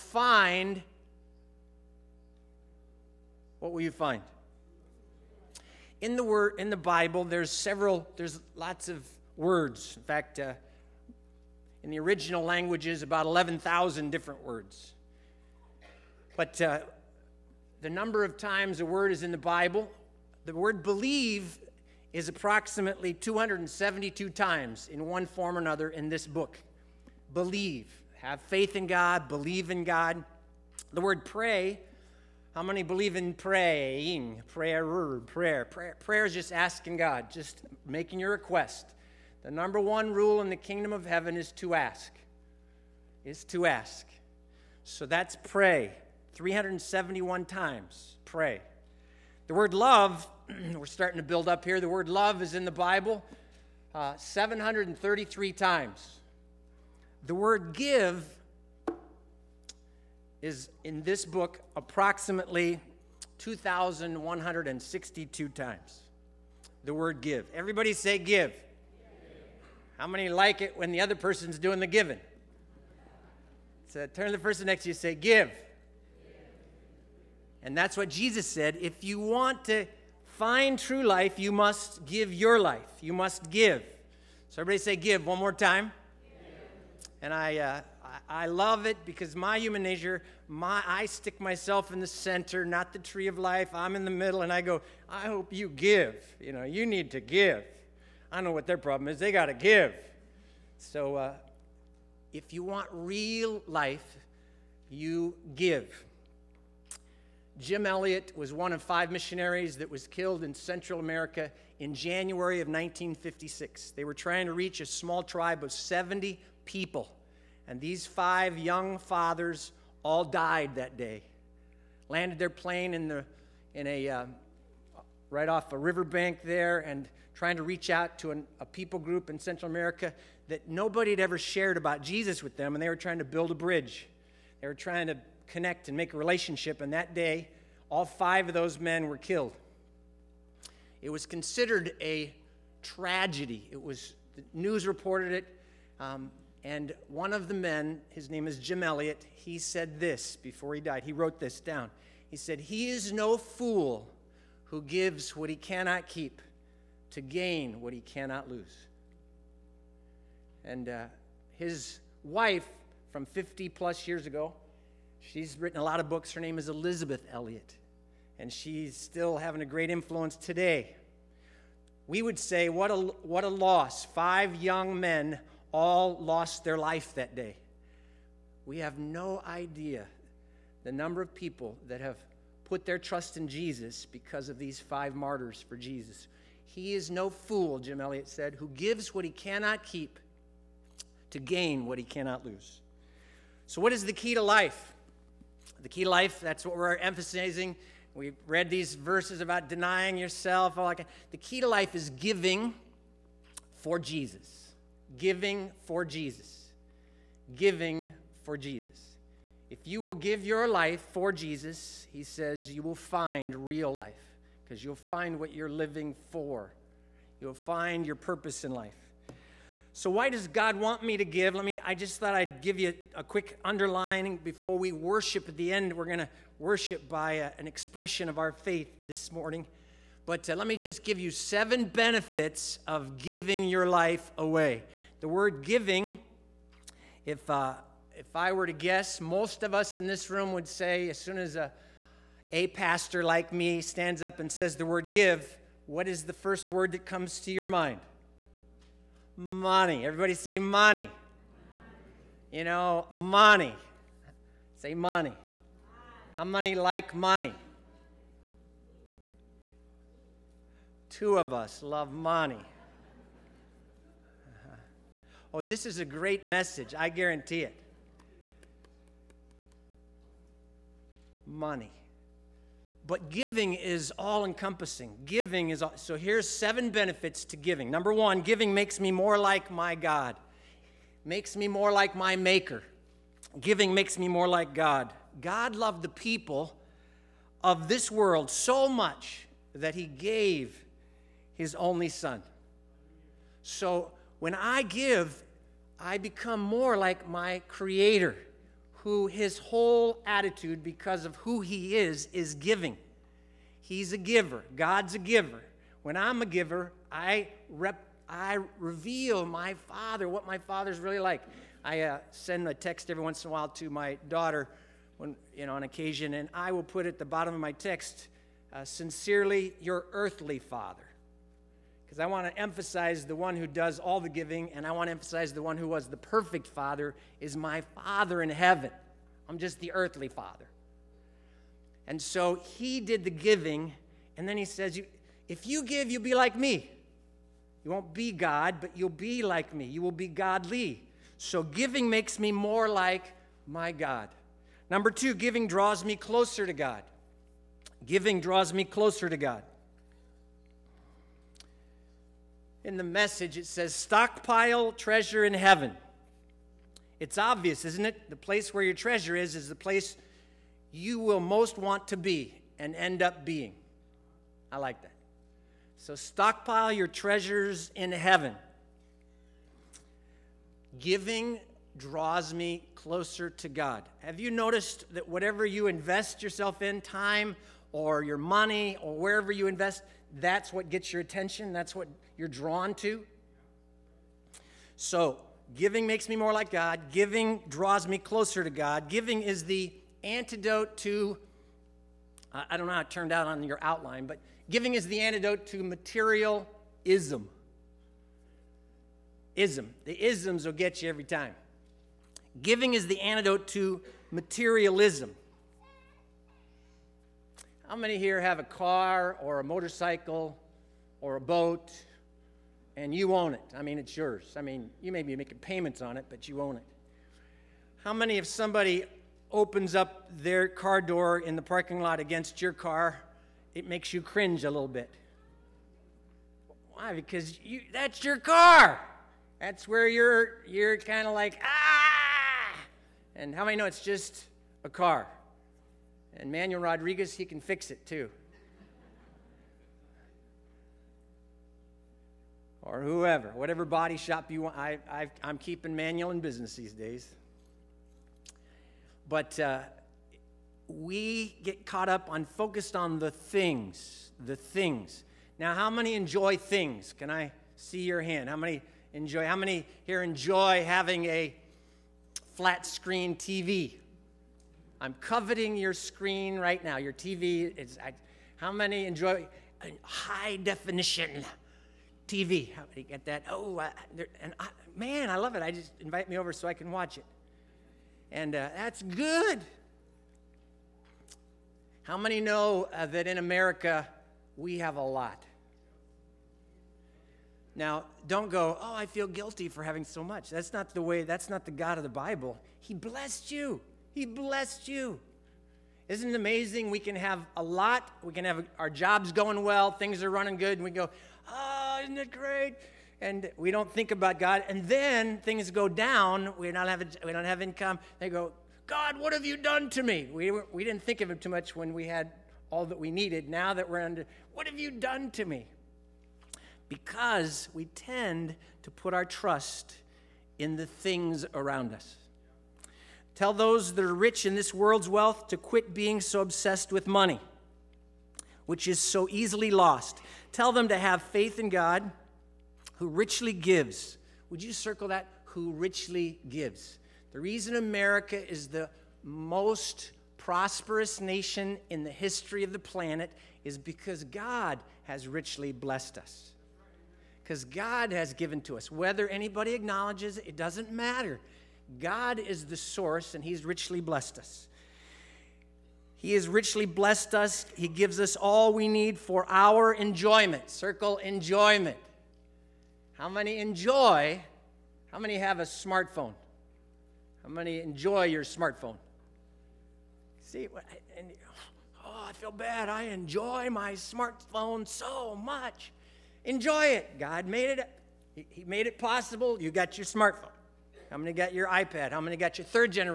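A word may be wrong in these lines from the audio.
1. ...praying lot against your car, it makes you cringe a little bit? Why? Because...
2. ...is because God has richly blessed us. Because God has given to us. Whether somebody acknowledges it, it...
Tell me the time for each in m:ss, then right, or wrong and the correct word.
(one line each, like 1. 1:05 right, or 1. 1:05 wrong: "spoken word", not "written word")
1. 7:01 wrong: "parking", not "praying"
2. 9:03 wrong: "anybody", not "somebody".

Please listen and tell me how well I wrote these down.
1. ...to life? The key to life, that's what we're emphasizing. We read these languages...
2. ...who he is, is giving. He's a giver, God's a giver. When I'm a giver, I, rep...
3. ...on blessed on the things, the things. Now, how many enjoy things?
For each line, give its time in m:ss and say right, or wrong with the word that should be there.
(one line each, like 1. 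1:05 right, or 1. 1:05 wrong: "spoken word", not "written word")
1. 3:14 wrong: "verses", not "languages"
2. 5:01 right
3. 7:32 wrong: "focused", not "blessed".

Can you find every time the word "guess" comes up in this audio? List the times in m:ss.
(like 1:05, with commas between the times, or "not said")
3:58.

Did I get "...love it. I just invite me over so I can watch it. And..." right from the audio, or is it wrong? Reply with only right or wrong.
right.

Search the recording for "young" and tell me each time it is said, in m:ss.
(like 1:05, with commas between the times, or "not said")
1:58, 2:54.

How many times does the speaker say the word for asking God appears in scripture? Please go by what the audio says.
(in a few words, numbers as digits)
371.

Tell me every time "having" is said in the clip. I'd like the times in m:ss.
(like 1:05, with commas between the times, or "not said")
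2:49, 7:40, 8:09.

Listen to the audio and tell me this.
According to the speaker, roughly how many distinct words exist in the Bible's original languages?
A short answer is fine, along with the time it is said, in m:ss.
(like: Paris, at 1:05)
11000, at 0:13.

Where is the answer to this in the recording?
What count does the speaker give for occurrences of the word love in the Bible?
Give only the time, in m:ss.
0:54.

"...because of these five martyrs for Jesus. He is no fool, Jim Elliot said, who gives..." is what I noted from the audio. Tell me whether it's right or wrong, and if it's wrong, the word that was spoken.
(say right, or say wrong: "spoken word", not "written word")
right.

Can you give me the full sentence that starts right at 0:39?
The number one rule in the kingdom of heaven is to ask.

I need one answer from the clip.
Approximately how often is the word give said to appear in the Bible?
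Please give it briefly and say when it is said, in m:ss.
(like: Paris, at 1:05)
2,162, at 1:03.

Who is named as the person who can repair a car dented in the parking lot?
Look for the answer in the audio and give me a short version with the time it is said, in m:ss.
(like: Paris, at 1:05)
Manuel Rodriguez, at 7:16.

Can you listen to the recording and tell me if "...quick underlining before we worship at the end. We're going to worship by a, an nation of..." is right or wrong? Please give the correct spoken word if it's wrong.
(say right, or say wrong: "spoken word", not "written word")
wrong: "expression", not "nation".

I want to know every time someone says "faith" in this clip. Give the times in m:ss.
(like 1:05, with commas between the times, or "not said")
0:28, 3:48, 8:51.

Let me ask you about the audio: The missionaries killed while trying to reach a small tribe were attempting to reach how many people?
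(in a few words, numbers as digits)
70.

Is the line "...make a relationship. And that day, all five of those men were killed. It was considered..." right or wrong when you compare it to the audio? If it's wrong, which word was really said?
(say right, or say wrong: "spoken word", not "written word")
right.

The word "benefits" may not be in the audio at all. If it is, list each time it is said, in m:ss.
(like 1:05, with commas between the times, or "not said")
3:51, 4:36.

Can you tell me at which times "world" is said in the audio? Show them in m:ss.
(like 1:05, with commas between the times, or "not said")
4:48, 8:44.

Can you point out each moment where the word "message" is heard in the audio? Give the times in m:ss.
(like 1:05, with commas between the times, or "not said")
4:26, 5:53.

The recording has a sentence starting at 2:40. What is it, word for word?
And uh, his wife from 50 plus years ago, she's written a lot of books.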